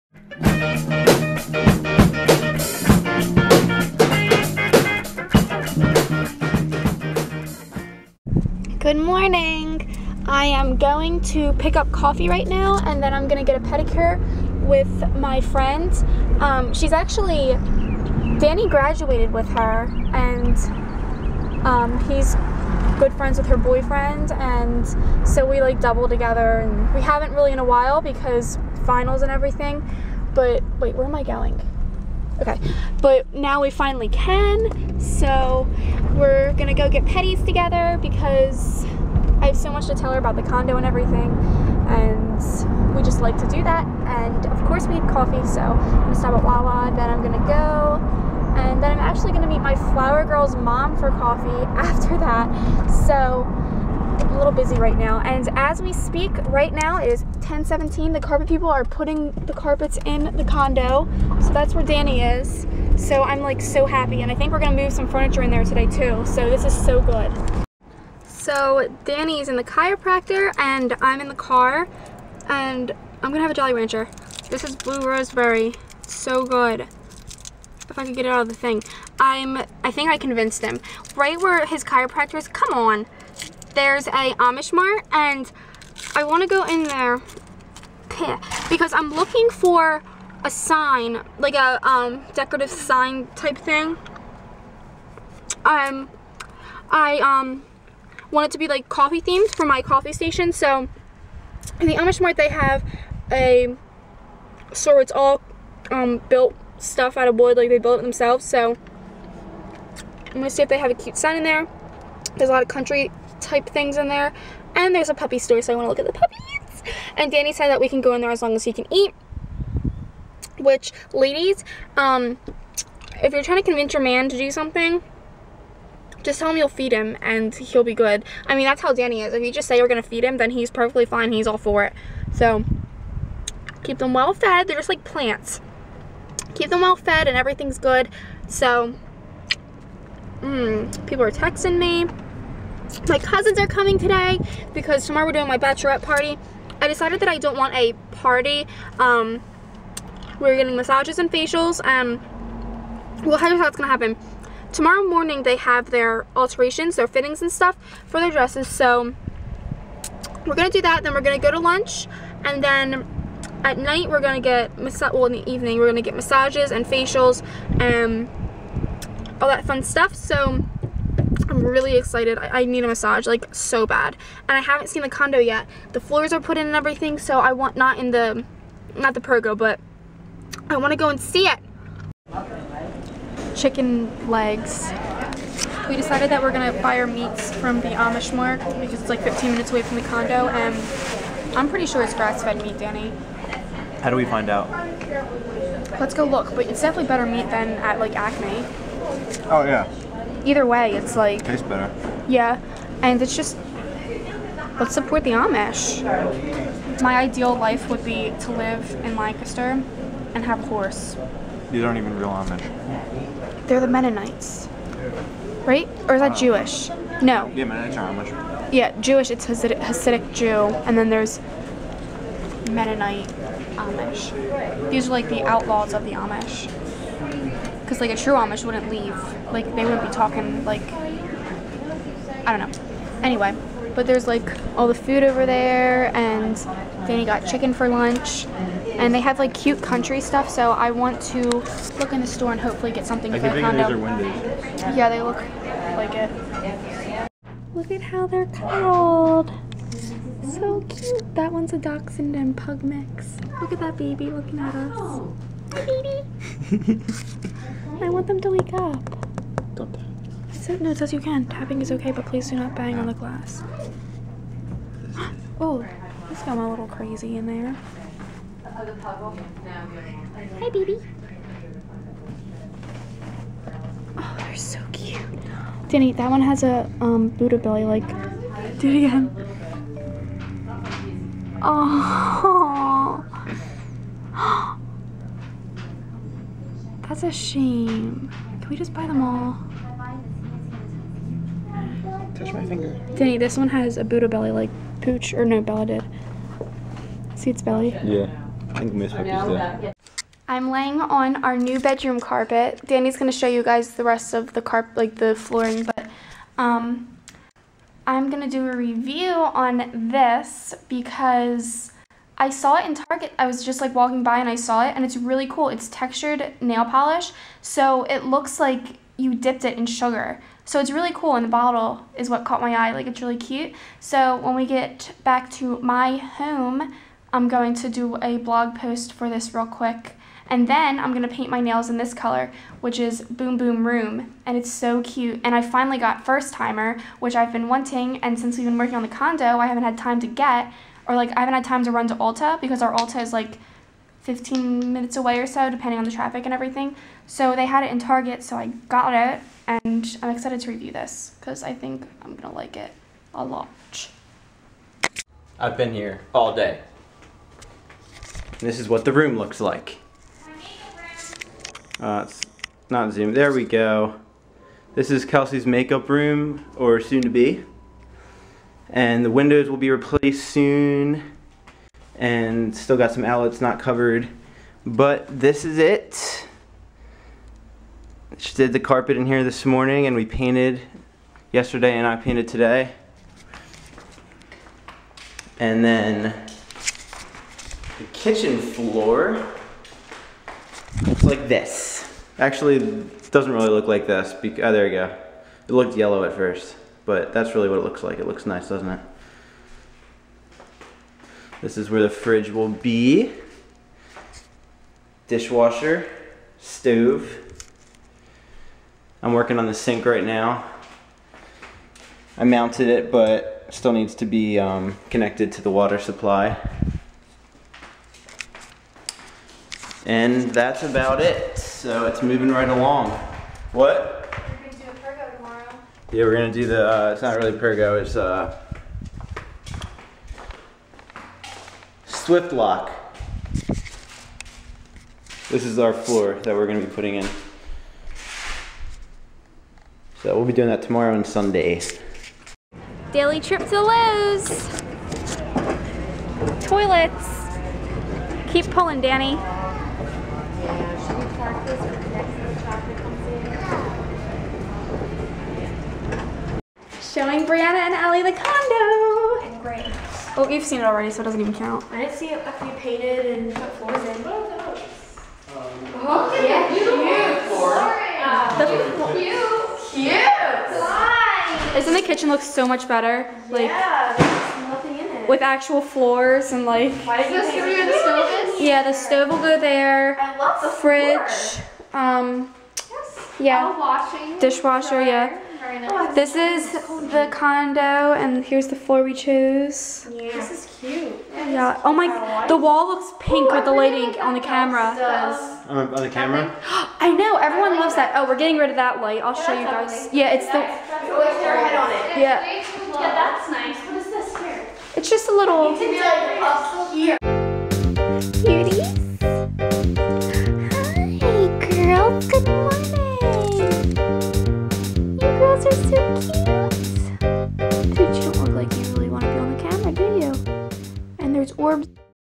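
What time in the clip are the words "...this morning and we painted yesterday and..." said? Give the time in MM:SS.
06:19.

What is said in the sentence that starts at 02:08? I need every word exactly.
I mean, that's how Danny is.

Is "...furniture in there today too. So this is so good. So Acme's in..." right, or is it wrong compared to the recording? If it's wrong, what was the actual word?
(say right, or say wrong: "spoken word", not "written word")
wrong: "Danny", not "Acme".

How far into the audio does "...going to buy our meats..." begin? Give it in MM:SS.
03:06.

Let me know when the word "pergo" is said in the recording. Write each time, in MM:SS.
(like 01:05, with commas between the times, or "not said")
02:59, 07:07.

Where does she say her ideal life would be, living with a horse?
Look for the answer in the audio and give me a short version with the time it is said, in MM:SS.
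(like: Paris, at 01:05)
Lancaster, at 03:29.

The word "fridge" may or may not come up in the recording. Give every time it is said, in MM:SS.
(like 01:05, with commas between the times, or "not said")
06:42, 08:00.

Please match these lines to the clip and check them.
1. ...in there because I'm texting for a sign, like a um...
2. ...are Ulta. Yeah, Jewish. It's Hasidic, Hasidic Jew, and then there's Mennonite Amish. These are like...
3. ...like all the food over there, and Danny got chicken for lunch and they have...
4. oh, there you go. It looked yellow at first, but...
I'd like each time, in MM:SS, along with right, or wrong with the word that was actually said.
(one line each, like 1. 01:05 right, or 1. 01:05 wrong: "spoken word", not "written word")
1. 01:26 wrong: "looking", not "texting"
2. 03:37 wrong: "Amish", not "Ulta"
3. 03:54 right
4. 06:34 right.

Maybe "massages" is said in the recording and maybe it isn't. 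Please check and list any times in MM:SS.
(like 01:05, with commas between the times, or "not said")
02:30, 02:46, 02:52.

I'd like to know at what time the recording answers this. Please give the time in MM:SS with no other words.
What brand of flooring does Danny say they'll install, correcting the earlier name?
07:12.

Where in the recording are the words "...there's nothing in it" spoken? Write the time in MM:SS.
07:54.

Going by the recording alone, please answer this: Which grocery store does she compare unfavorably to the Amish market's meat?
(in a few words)
Acme.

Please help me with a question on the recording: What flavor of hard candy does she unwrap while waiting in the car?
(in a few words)
Blue Raspberry.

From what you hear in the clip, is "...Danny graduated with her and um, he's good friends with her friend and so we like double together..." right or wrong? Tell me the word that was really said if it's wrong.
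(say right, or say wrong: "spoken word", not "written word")
wrong: "boyfriend", not "friend".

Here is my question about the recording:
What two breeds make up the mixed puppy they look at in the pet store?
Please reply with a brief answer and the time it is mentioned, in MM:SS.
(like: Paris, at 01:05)
Dachshund and pug, at 04:11.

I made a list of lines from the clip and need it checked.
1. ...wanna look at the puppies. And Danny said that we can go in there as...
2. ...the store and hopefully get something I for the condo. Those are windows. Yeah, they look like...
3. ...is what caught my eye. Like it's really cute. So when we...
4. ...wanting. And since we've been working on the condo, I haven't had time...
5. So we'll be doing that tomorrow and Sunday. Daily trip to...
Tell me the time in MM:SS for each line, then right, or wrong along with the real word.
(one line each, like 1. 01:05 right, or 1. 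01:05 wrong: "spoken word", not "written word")
1. 01:55 right
2. 04:02 right
3. 05:22 right
4. 05:37 right
5. 07:20 right.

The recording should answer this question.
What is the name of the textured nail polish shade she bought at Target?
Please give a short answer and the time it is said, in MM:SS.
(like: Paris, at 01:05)
Boom Boom Room, at 05:33.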